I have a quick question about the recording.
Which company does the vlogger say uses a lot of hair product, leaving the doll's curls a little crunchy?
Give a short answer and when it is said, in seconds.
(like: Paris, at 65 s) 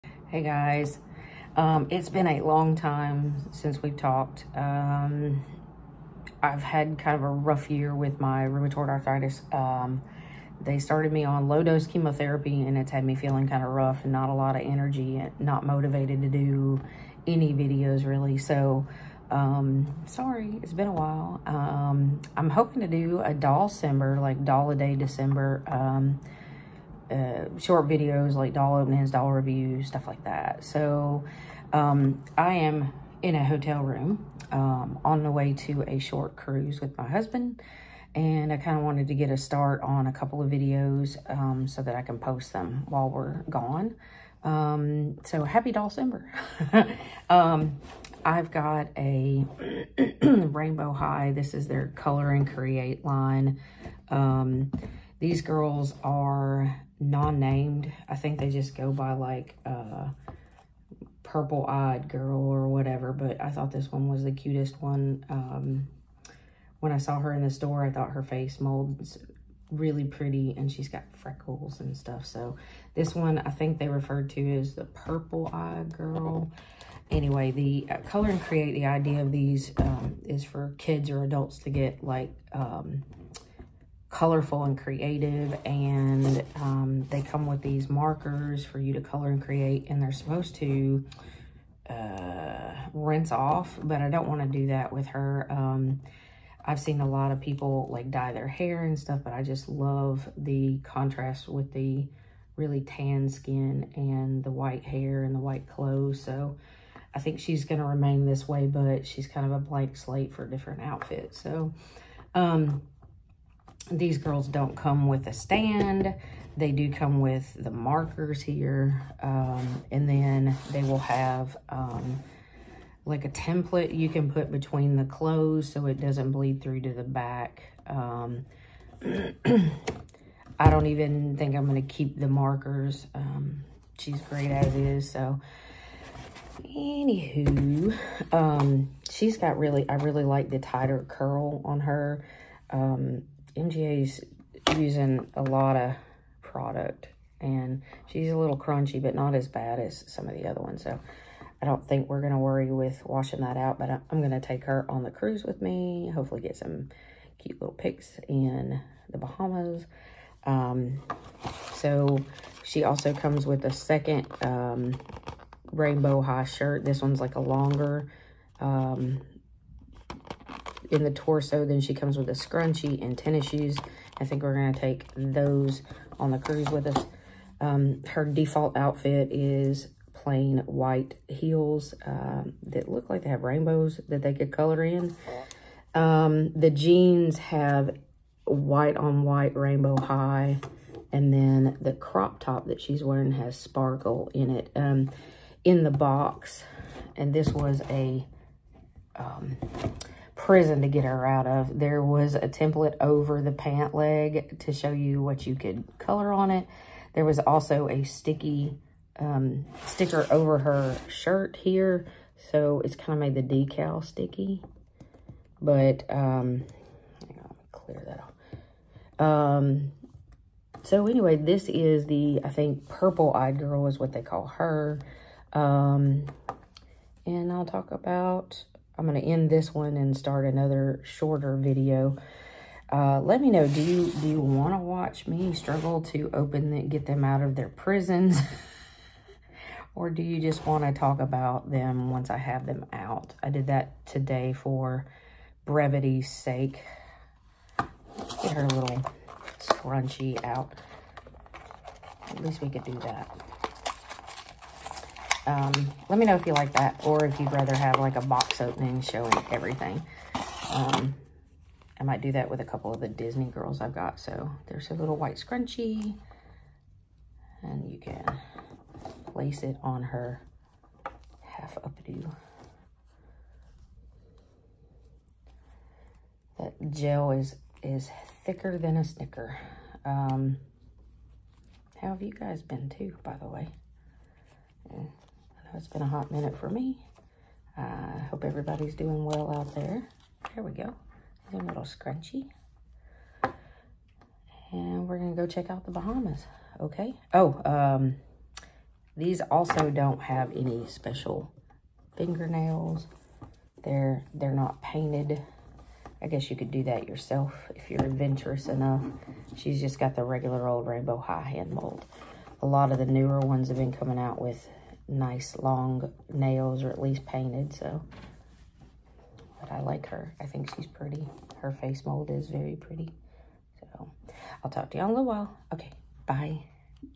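MGA, at 143 s.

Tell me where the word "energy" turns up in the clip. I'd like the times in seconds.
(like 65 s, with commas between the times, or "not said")
14 s.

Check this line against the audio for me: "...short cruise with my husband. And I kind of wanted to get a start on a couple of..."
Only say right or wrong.
right.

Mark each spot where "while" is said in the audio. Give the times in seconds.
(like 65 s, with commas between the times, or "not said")
20 s, 42 s, 325 s.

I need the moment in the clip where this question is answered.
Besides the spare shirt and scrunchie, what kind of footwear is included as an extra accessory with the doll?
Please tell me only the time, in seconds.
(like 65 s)
173 s.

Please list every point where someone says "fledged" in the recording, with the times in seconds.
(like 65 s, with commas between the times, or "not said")
not said.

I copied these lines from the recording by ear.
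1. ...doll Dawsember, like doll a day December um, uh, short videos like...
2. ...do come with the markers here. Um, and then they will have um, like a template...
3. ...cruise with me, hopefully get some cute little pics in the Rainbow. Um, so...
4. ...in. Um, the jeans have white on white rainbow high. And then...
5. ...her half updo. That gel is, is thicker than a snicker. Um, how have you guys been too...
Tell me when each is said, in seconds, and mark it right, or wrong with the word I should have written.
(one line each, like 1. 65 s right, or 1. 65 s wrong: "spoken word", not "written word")
1. 23 s wrong: "December", not "Dawsember"
2. 116 s right
3. 155 s wrong: "Bahamas", not "Rainbow"
4. 184 s right
5. 270 s right.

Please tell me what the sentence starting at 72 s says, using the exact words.
So this one, I think they referred to as the purple eye girl.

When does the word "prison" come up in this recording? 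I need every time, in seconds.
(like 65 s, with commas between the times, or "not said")
200 s, 237 s.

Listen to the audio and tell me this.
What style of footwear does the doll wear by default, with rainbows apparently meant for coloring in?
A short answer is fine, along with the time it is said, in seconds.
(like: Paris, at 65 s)
white heels, at 180 s.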